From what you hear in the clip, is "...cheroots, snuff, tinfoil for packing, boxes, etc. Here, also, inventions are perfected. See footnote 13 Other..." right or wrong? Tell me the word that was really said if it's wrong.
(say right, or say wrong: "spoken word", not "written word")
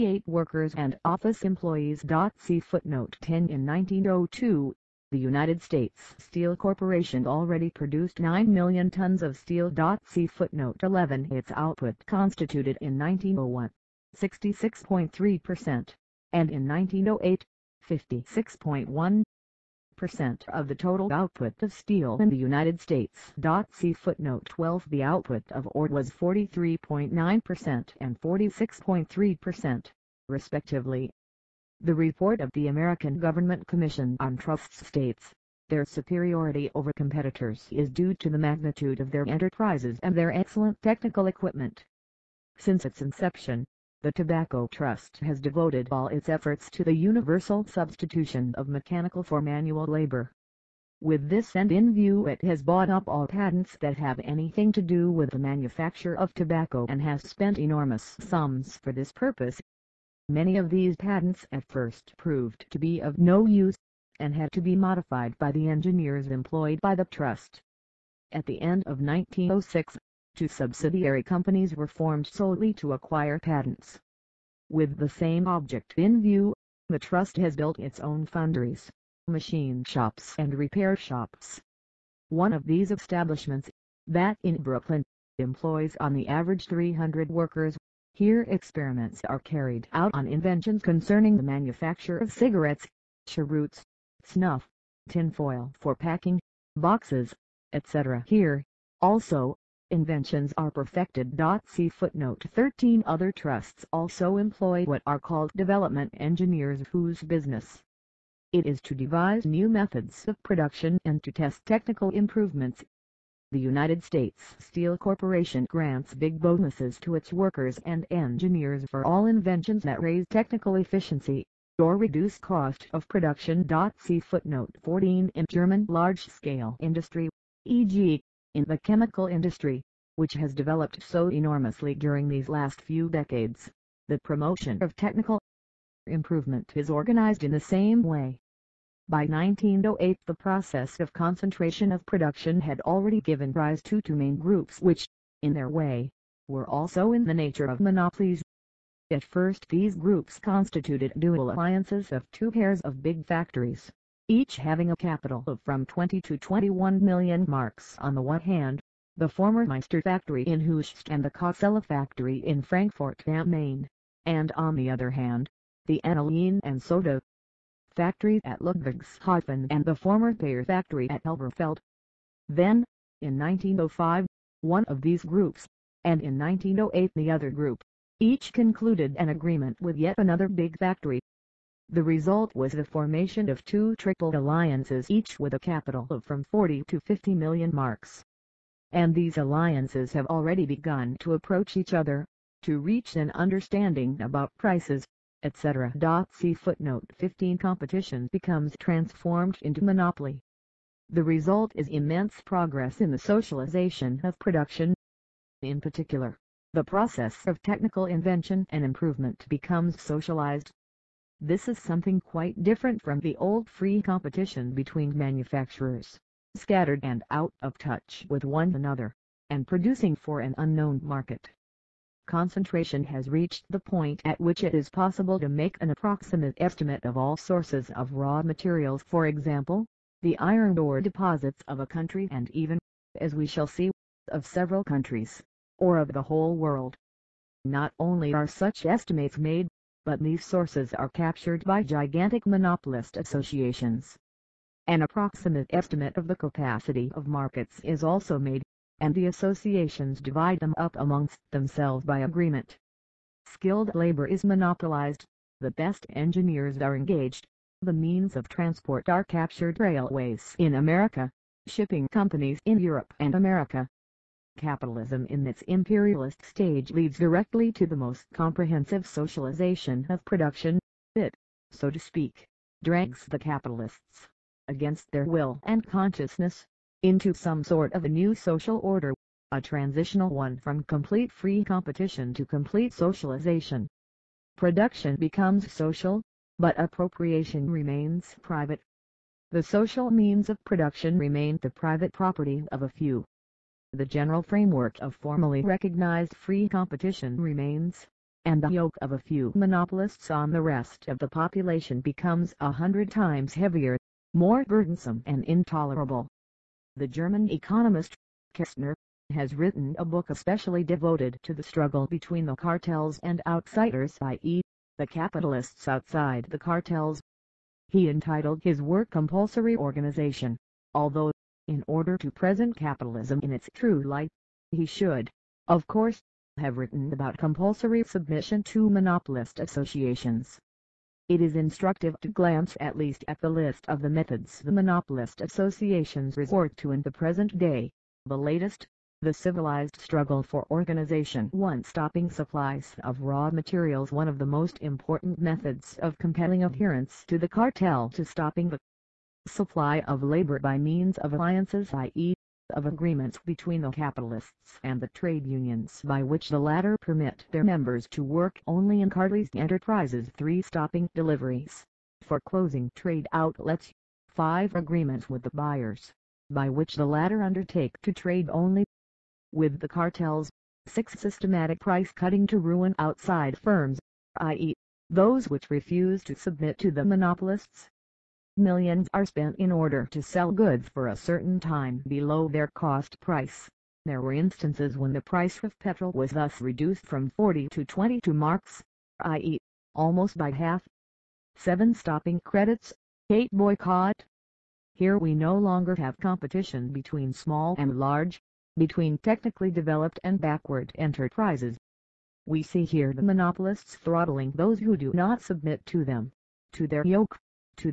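right.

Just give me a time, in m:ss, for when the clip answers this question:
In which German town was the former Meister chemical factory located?
2:40.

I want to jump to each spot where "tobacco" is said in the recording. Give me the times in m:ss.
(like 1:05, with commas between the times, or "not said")
0:44, 0:56.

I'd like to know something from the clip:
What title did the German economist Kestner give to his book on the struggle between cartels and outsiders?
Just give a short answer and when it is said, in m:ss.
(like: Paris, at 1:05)
Compulsory Organization, at 5:19.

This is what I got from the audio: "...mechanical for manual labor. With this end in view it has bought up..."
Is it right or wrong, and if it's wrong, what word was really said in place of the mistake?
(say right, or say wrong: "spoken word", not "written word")
right.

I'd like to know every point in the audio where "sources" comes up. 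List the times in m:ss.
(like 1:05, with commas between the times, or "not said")
3:47, 4:00.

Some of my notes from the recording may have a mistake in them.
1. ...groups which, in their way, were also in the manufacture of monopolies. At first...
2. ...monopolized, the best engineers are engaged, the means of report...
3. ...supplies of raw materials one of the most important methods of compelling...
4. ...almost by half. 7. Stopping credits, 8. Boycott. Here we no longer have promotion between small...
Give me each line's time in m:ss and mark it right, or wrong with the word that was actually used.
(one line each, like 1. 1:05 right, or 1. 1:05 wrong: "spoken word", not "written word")
1. 2:24 wrong: "nature", not "manufacture"
2. 4:14 wrong: "transport", not "report"
3. 5:42 right
4. 6:29 wrong: "competition", not "promotion".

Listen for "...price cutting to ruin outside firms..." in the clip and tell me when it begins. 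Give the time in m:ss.
6:11.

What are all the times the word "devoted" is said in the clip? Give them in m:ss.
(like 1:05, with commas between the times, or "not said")
0:45, 5:10.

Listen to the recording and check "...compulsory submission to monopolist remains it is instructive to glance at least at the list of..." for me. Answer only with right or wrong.
wrong.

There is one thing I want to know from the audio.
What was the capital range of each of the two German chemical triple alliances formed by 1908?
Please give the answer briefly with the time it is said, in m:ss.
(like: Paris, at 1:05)
40 to 50 million marks, at 3:06.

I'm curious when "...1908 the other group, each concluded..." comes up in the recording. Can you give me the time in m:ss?
2:56.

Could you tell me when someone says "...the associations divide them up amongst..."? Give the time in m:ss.
4:09.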